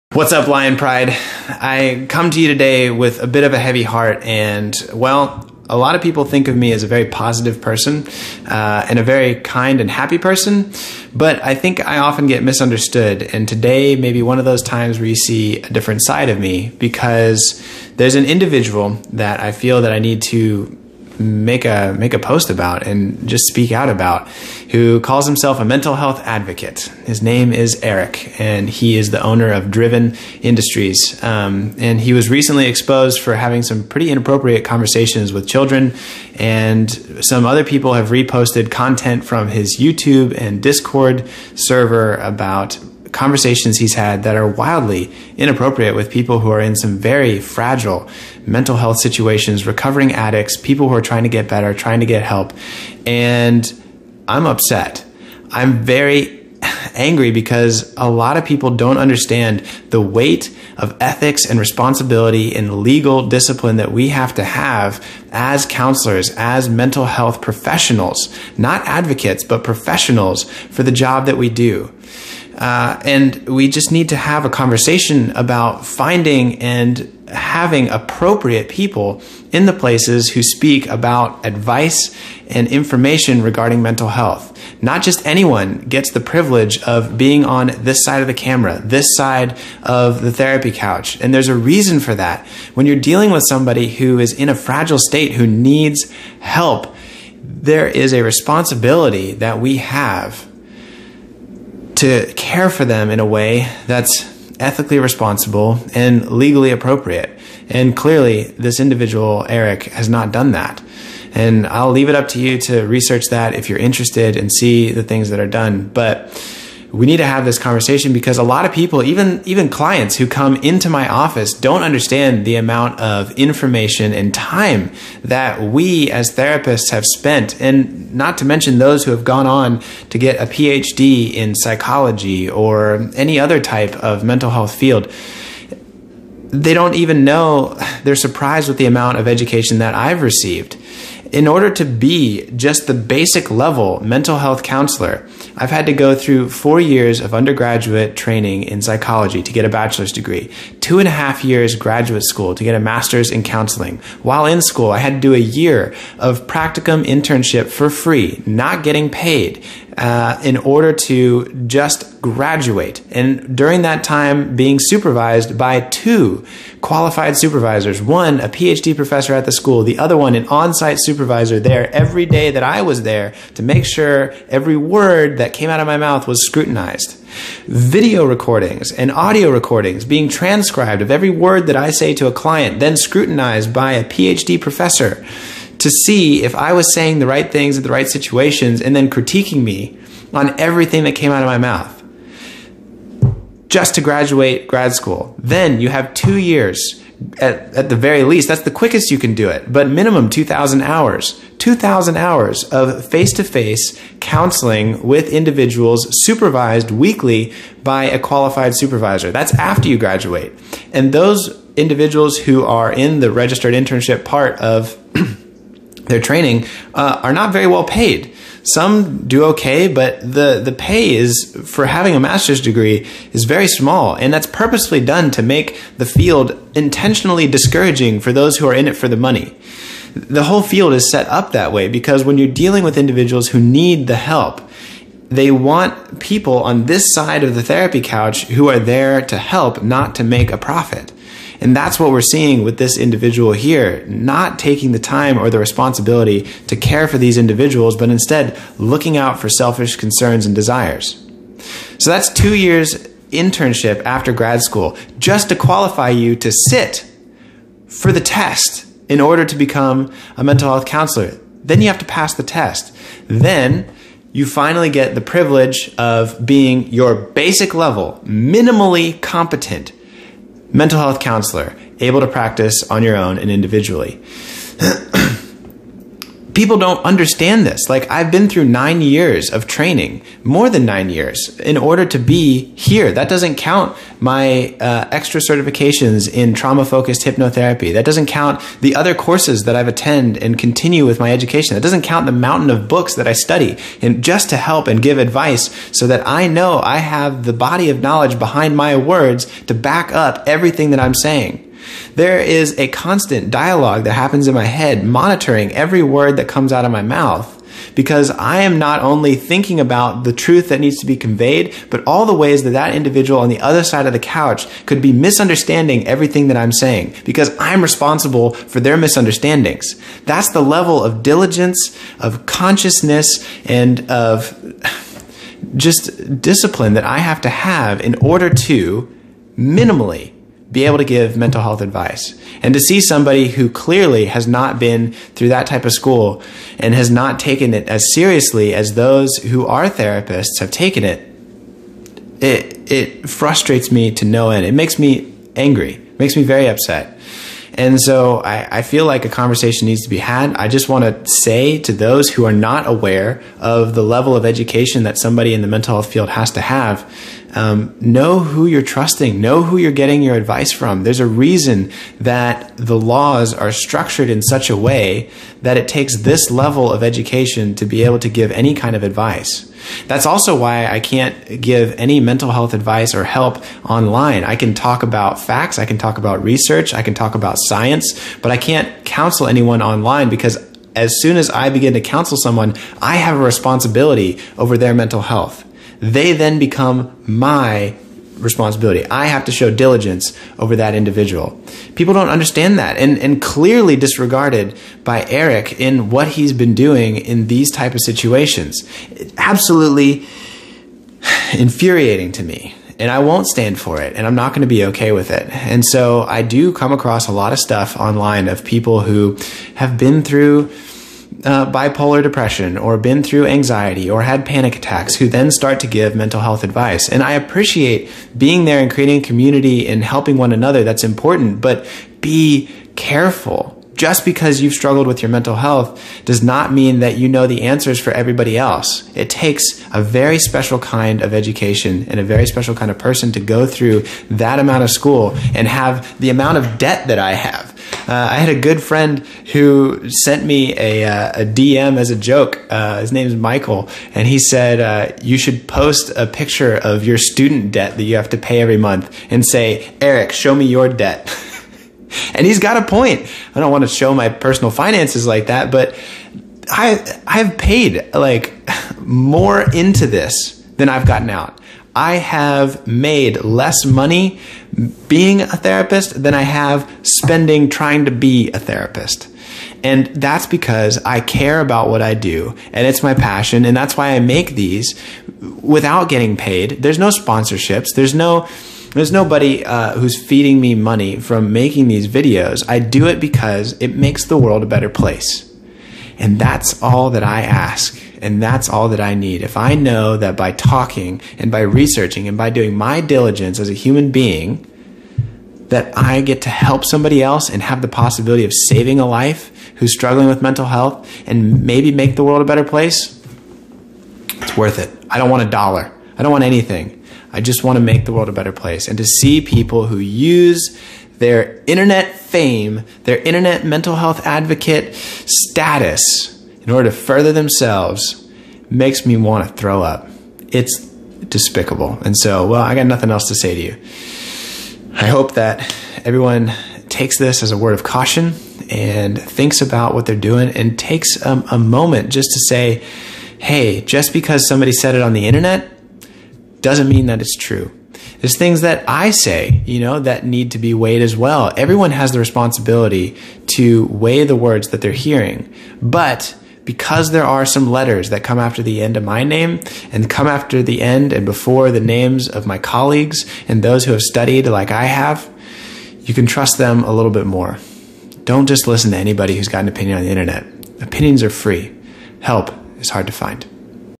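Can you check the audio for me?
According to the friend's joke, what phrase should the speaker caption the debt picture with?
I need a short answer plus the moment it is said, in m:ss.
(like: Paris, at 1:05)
Eric, show me your debt, at 7:30.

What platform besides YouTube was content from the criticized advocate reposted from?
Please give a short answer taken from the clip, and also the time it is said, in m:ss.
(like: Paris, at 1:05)
Discord, at 0:40.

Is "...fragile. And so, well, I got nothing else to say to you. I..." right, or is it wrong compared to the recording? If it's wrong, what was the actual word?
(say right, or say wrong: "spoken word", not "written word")
wrong: "despicable", not "fragile".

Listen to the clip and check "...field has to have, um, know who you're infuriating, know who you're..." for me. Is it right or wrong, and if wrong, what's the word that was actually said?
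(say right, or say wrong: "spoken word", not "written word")
wrong: "trusting", not "infuriating".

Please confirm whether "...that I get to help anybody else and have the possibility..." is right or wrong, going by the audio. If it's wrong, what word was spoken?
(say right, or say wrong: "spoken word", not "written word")
wrong: "somebody", not "anybody".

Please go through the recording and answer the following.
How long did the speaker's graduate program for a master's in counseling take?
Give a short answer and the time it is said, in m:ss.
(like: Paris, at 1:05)
2.5 years, at 2:30.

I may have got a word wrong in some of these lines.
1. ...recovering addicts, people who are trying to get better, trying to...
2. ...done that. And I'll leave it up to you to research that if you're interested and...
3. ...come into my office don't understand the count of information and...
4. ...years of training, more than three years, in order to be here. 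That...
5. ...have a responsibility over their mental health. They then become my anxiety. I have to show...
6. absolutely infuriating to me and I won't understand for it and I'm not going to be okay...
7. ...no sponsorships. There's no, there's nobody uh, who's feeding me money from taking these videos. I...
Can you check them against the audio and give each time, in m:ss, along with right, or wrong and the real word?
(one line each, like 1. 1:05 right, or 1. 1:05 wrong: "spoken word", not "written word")
1. 0:49 right
2. 1:50 right
3. 2:00 wrong: "amount", not "count"
4. 4:39 wrong: "nine", not "three"
5. 6:23 wrong: "responsibility", not "anxiety"
6. 6:39 wrong: "stand", not "understand"
7. 7:56 wrong: "making", not "taking".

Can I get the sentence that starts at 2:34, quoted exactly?
While in school, I had to do a year of practicum internship for free, not getting paid.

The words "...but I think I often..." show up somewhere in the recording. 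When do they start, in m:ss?
0:11.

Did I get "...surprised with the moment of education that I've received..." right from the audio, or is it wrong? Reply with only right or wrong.
wrong.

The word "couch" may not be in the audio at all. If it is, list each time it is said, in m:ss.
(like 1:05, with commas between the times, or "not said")
1:30, 3:58, 5:14.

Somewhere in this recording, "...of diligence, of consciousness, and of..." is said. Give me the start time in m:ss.
5:21.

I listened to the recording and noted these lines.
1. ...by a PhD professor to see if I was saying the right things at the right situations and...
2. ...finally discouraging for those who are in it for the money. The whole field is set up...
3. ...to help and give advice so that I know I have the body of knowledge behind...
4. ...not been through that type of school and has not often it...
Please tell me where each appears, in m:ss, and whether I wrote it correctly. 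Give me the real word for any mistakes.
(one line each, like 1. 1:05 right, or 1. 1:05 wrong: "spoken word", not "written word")
1. 3:03 right
2. 3:46 wrong: "intentionally", not "finally"
3. 4:54 right
4. 5:34 wrong: "taken", not "often".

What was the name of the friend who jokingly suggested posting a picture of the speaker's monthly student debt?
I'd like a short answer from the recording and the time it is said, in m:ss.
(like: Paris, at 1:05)
Michael, at 7:23.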